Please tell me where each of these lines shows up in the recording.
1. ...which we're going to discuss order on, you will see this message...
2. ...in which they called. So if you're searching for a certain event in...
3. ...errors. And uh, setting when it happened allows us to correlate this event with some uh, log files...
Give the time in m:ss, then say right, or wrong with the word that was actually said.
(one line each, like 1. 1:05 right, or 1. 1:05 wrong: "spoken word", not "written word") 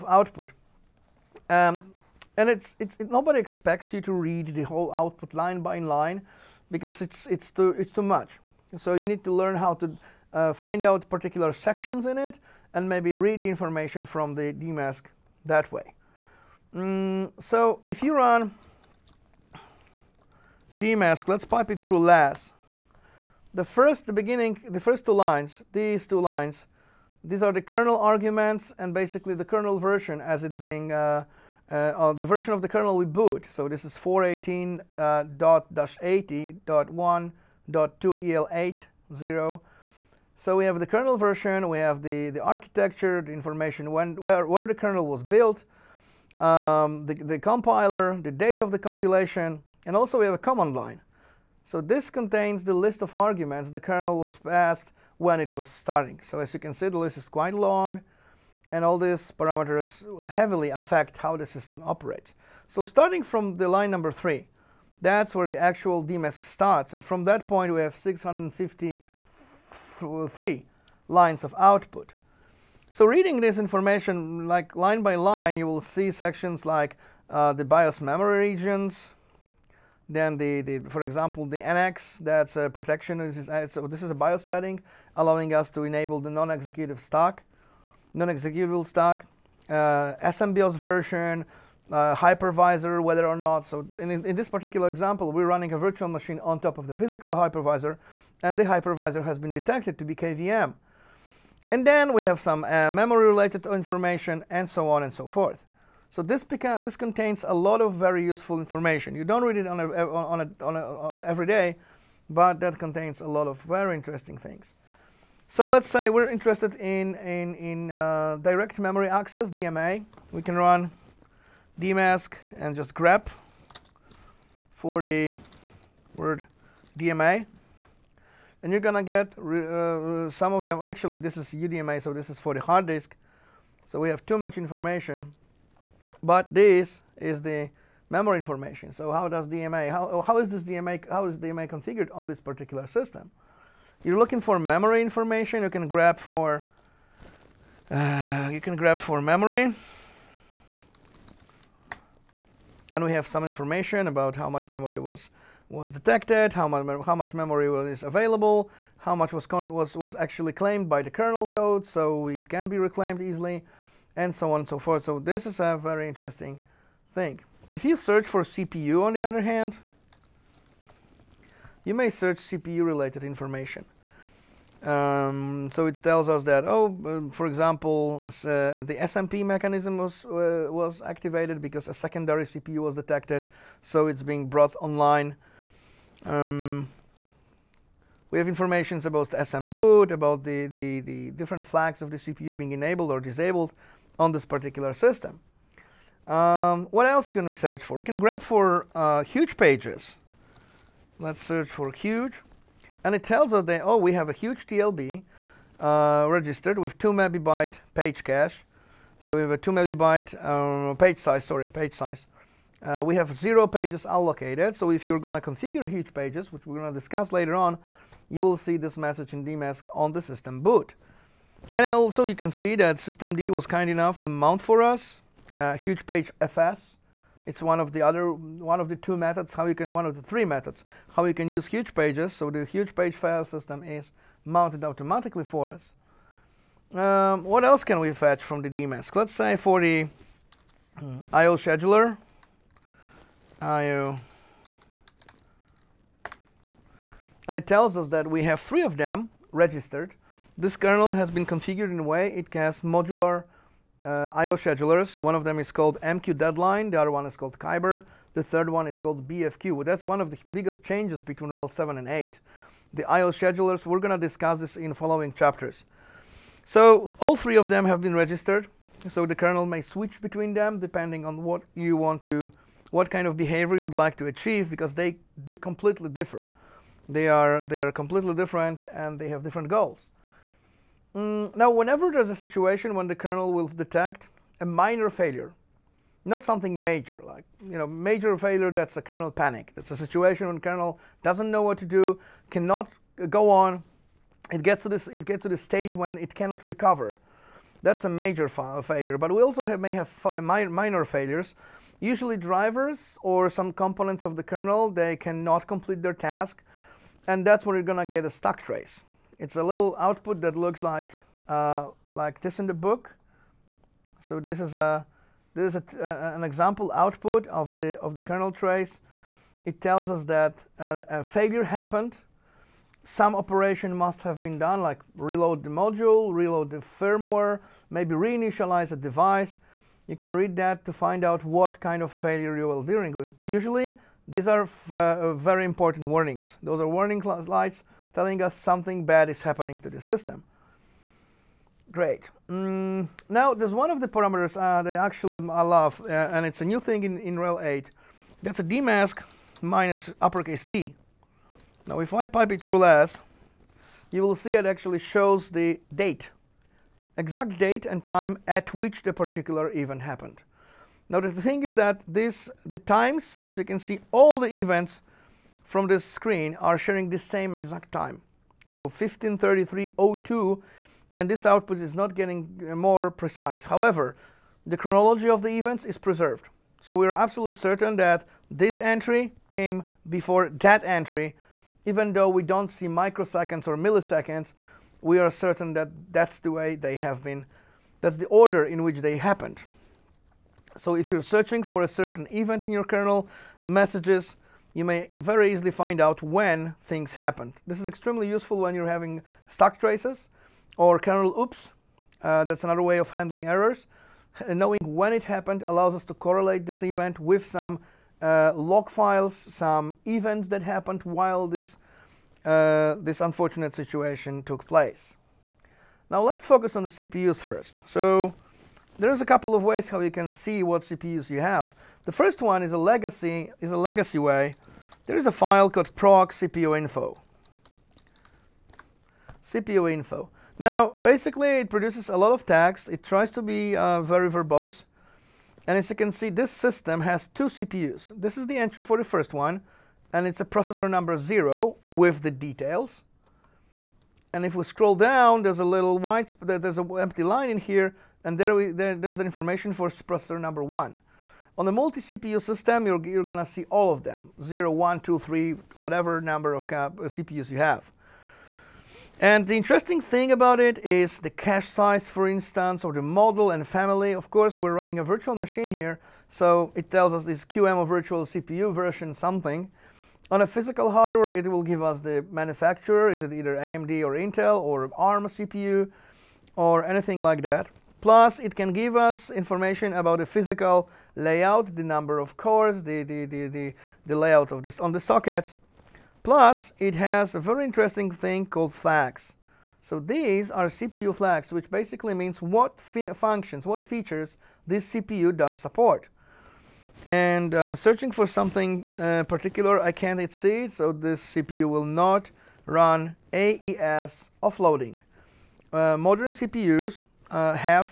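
1. 3:36 wrong: "later", not "order"
2. 6:28 wrong: "happened", not "called"
3. 6:43 wrong: "knowing", not "setting".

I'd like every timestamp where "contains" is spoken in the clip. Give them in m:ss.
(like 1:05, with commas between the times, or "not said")
0:52, 1:46, 1:52.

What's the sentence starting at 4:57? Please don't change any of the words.
That's a major fa failure, but we also have, may have minor failures.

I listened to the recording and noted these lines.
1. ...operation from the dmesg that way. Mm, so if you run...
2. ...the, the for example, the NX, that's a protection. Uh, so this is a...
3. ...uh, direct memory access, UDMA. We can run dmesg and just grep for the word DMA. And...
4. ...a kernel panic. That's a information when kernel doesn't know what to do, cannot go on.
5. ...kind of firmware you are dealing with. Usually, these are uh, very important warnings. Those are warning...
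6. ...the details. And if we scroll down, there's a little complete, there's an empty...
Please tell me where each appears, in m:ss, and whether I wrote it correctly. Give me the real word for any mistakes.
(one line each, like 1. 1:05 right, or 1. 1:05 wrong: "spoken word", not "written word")
1. 0:13 wrong: "information", not "operation"
2. 1:20 right
3. 1:57 wrong: "DMA", not "UDMA"
4. 4:48 wrong: "situation", not "information"
5. 5:31 wrong: "failure", not "firmware"
6. 7:22 wrong: "white", not "complete".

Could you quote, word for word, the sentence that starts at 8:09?
So these are CPU flags, which basically means what functions, what features this CPU does support.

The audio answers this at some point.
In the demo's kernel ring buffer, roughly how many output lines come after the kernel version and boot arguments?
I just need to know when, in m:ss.
1:07.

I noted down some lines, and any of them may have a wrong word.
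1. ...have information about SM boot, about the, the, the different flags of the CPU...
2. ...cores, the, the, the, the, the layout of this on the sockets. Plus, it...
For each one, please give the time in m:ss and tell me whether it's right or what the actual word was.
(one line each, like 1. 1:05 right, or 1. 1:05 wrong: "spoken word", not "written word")
1. 3:08 right
2. 8:02 right.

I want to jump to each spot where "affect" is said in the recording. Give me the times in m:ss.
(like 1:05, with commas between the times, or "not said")
1:00.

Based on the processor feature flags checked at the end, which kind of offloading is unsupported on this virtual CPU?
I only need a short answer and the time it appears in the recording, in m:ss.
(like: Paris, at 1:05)
AES, at 8:23.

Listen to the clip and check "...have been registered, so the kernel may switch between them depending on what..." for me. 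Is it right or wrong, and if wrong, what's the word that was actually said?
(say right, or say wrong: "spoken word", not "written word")
right.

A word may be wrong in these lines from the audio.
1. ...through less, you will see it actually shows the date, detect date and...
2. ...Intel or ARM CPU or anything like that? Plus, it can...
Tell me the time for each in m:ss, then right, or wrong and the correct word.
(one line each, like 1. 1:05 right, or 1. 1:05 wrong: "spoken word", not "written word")
1. 5:52 wrong: "exact", not "detect"
2. 7:54 right.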